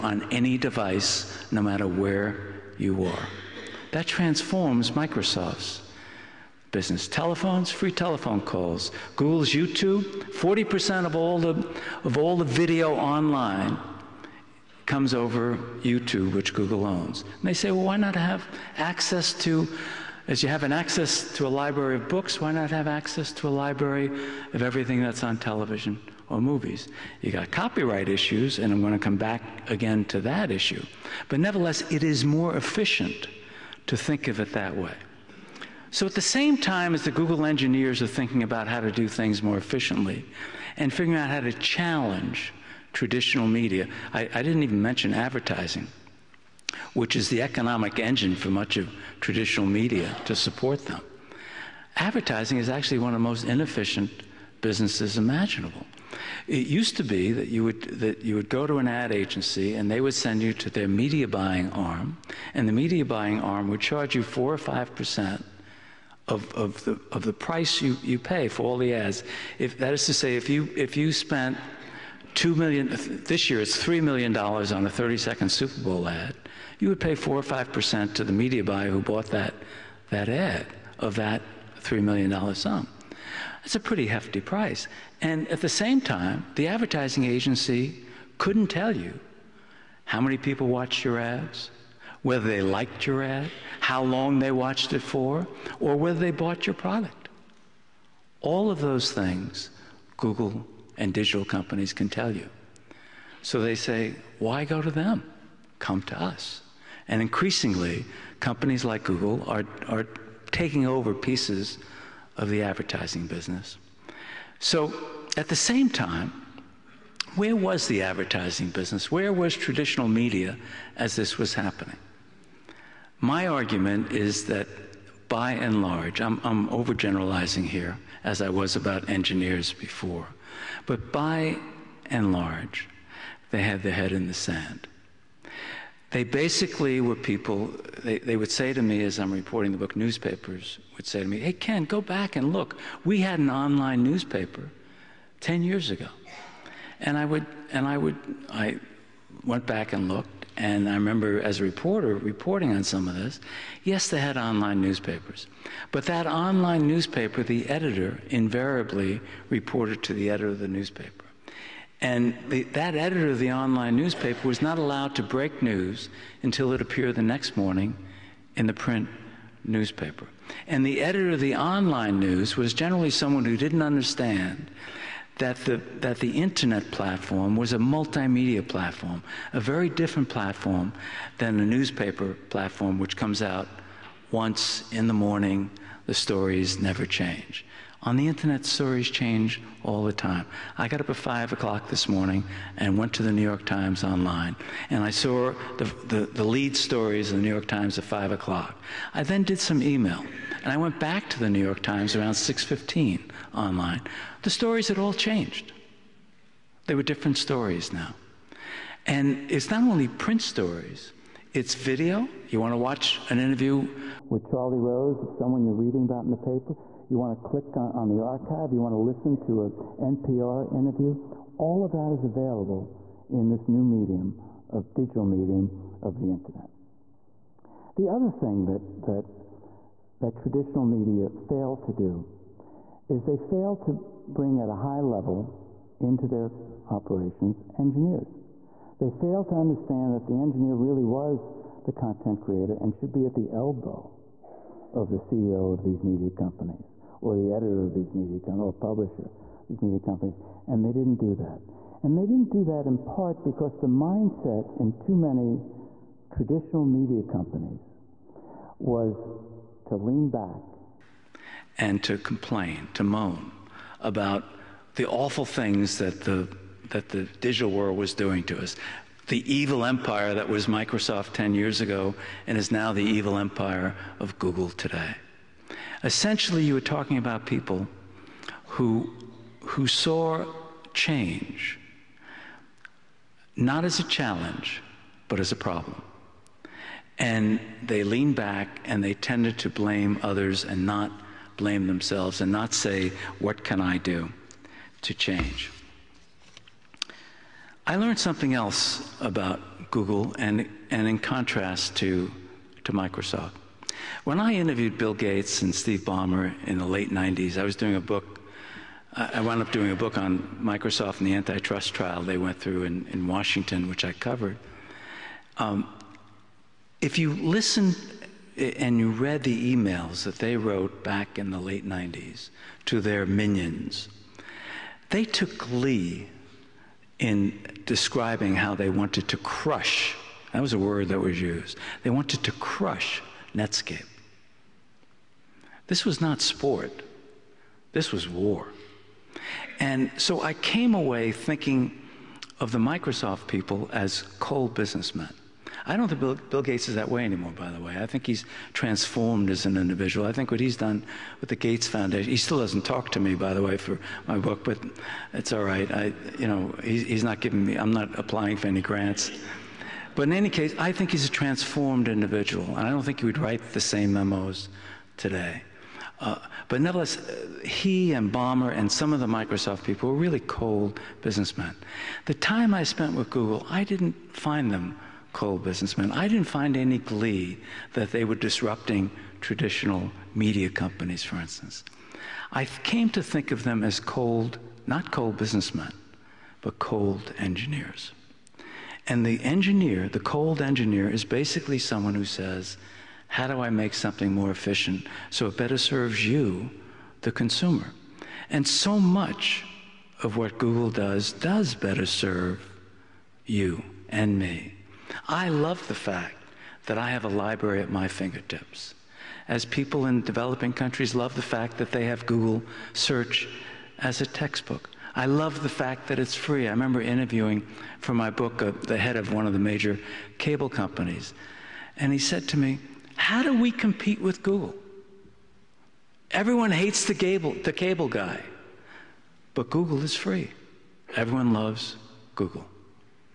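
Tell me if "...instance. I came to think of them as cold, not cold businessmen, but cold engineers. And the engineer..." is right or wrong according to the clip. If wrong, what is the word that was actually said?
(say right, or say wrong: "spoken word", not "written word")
right.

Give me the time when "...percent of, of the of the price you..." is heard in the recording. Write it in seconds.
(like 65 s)
64 s.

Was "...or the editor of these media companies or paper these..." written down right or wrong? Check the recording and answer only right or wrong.
wrong.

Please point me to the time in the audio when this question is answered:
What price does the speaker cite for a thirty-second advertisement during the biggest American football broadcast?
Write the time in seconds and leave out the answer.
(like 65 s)
73 s.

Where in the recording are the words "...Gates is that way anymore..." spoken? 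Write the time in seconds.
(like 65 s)
346 s.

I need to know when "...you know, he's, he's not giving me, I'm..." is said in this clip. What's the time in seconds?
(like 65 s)
356 s.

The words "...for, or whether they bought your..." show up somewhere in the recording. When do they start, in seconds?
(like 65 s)
95 s.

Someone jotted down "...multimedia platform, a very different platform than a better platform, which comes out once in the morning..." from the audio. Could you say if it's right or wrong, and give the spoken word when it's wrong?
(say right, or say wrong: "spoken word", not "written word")
wrong: "newspaper", not "better".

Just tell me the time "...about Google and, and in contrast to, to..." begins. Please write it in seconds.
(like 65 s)
299 s.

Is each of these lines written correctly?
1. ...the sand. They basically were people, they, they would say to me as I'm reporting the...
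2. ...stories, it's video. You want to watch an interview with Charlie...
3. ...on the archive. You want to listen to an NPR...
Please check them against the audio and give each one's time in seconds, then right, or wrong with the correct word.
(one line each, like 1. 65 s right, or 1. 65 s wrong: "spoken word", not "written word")
1. 134 s right
2. 210 s right
3. 217 s right.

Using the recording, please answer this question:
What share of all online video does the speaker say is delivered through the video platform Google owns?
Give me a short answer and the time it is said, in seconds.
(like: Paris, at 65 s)
40%, at 10 s.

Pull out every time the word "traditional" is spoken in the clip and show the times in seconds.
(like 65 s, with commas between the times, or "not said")
42 s, 49 s, 119 s, 230 s, 256 s, 379 s.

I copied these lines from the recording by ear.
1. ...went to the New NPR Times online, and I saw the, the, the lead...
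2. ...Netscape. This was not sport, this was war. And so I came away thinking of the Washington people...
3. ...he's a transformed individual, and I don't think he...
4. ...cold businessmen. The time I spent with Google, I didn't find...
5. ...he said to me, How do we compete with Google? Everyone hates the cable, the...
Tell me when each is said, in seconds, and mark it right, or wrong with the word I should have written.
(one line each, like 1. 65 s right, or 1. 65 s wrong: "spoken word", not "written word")
1. 192 s wrong: "York", not "NPR"
2. 333 s wrong: "Microsoft", not "Washington"
3. 361 s right
4. 370 s right
5. 422 s right.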